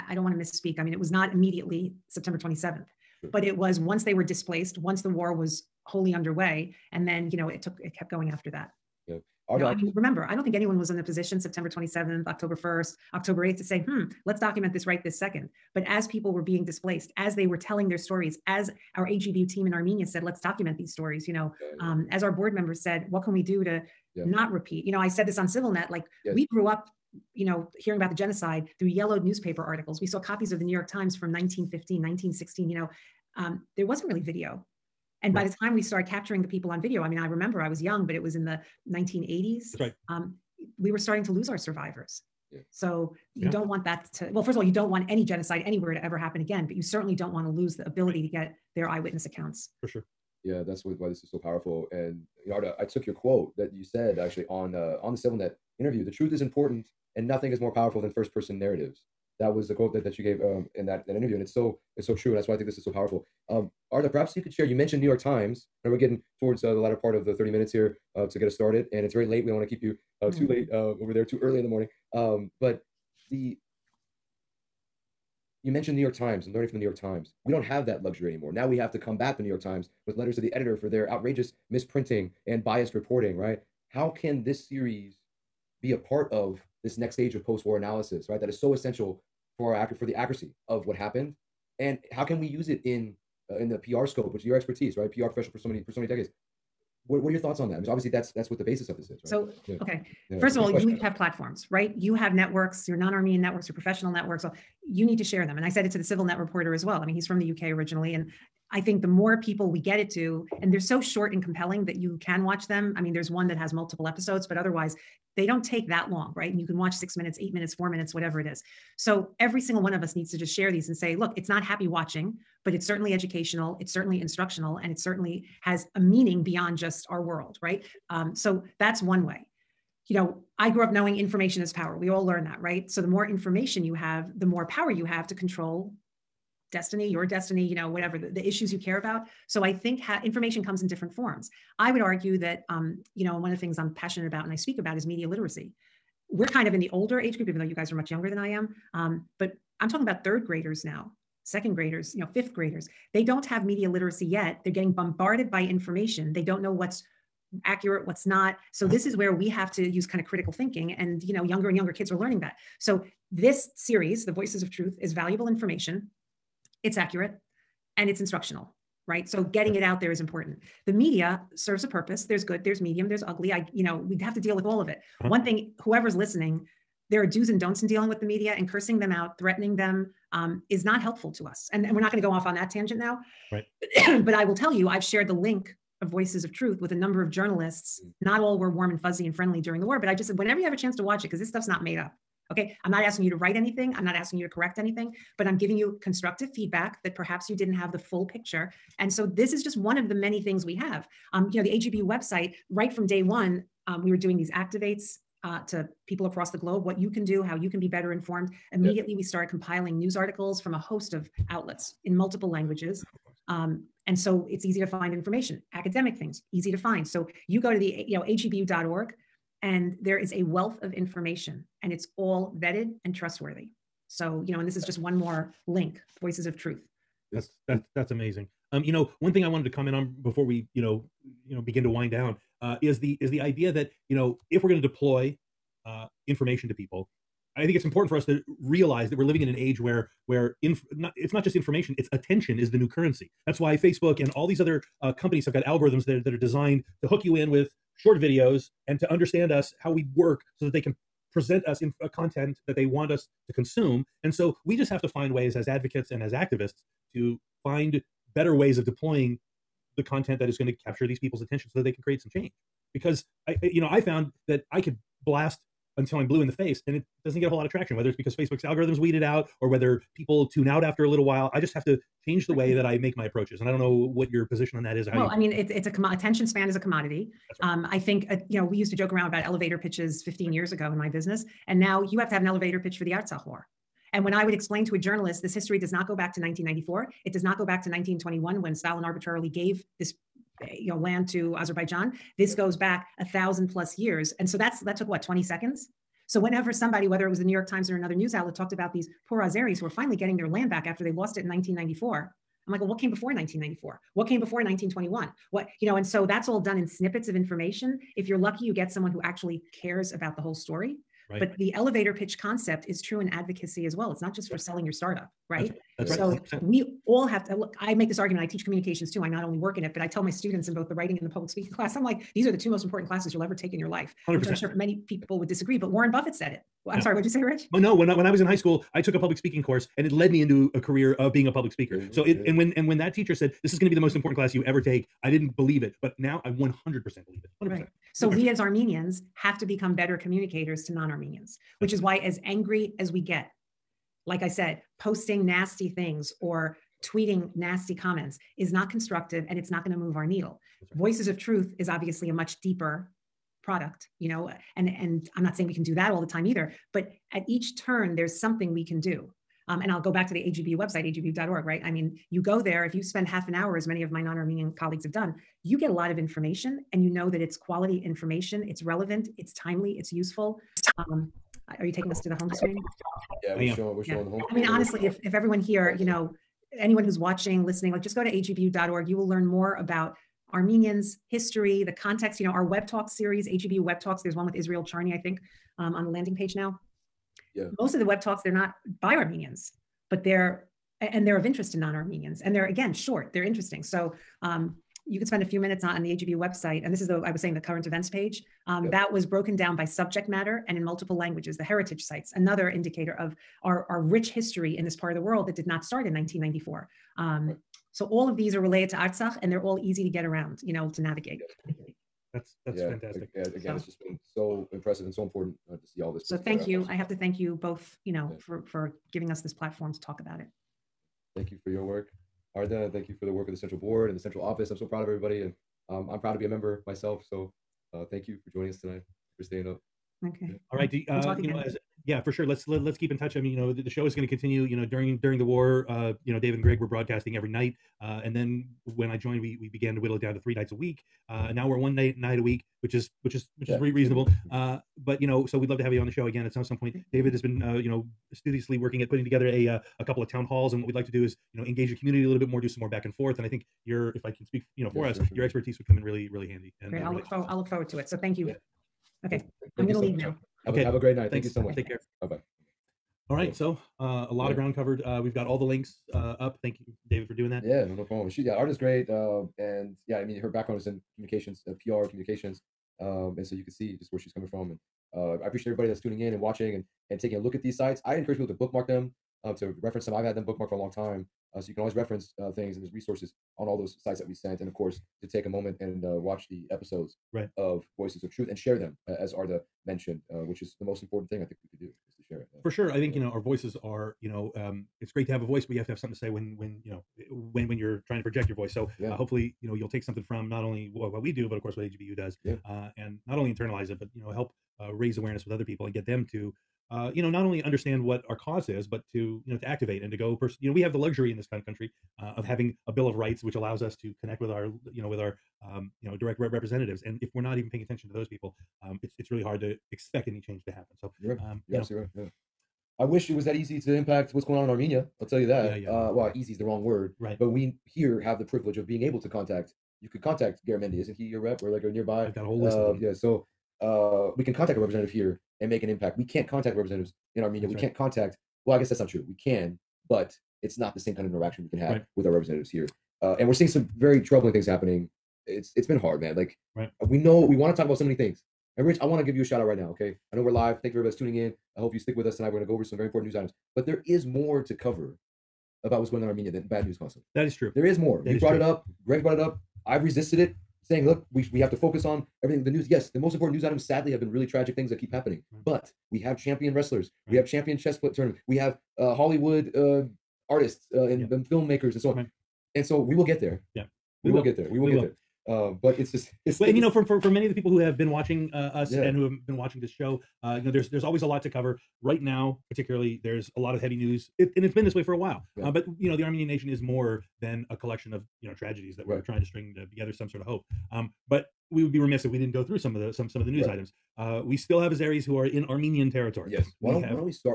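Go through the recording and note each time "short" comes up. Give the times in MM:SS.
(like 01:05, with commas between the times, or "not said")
01:50, 04:07, 06:32.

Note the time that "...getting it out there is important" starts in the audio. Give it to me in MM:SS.
02:49.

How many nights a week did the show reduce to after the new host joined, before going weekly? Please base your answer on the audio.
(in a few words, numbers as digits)
3.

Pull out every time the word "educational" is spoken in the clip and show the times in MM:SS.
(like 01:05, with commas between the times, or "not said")
02:03.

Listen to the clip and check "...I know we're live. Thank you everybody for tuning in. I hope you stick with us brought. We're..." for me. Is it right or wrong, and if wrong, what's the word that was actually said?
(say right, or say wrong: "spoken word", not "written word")
wrong: "tonight", not "brought".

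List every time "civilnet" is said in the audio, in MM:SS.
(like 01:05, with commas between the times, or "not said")
00:25, 00:55, 01:46.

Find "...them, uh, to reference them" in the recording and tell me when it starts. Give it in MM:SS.
07:58.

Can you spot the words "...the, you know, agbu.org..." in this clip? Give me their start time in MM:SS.
03:37.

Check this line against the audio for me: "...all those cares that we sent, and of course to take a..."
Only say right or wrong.
wrong.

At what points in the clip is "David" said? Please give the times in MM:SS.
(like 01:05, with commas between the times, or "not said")
07:16, 07:27, 07:47.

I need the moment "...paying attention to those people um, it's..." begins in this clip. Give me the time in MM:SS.
08:37.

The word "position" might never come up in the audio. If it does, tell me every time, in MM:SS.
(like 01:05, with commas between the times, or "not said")
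00:11, 04:34.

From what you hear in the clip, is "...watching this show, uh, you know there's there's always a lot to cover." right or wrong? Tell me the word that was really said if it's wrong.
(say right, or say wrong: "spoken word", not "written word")
right.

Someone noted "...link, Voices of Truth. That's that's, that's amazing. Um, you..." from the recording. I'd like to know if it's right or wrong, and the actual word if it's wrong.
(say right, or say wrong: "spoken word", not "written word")
right.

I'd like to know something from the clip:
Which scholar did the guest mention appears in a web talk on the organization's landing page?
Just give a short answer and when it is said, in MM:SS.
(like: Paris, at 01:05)
Israel Charny, at 06:24.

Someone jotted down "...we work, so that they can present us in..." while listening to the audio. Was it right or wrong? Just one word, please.
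right.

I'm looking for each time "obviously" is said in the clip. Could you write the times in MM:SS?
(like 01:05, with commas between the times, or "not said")
01:37, 05:51.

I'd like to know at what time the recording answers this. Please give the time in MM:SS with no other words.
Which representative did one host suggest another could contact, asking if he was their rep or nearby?
08:50.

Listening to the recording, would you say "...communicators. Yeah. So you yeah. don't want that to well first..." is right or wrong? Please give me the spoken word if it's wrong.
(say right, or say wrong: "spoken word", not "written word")
wrong: "survivors", not "communicators".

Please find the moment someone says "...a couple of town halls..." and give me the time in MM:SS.
07:29.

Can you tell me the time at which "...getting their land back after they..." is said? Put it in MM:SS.
05:00.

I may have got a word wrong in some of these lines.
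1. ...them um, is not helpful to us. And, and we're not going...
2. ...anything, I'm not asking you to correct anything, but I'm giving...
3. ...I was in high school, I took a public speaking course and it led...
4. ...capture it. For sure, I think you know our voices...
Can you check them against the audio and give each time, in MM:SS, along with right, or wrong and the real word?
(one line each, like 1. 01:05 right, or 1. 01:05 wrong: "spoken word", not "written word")
1. 02:59 right
2. 03:13 right
3. 05:28 right
4. 08:12 wrong: "share", not "capture".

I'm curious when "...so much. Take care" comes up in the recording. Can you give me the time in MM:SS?
07:41.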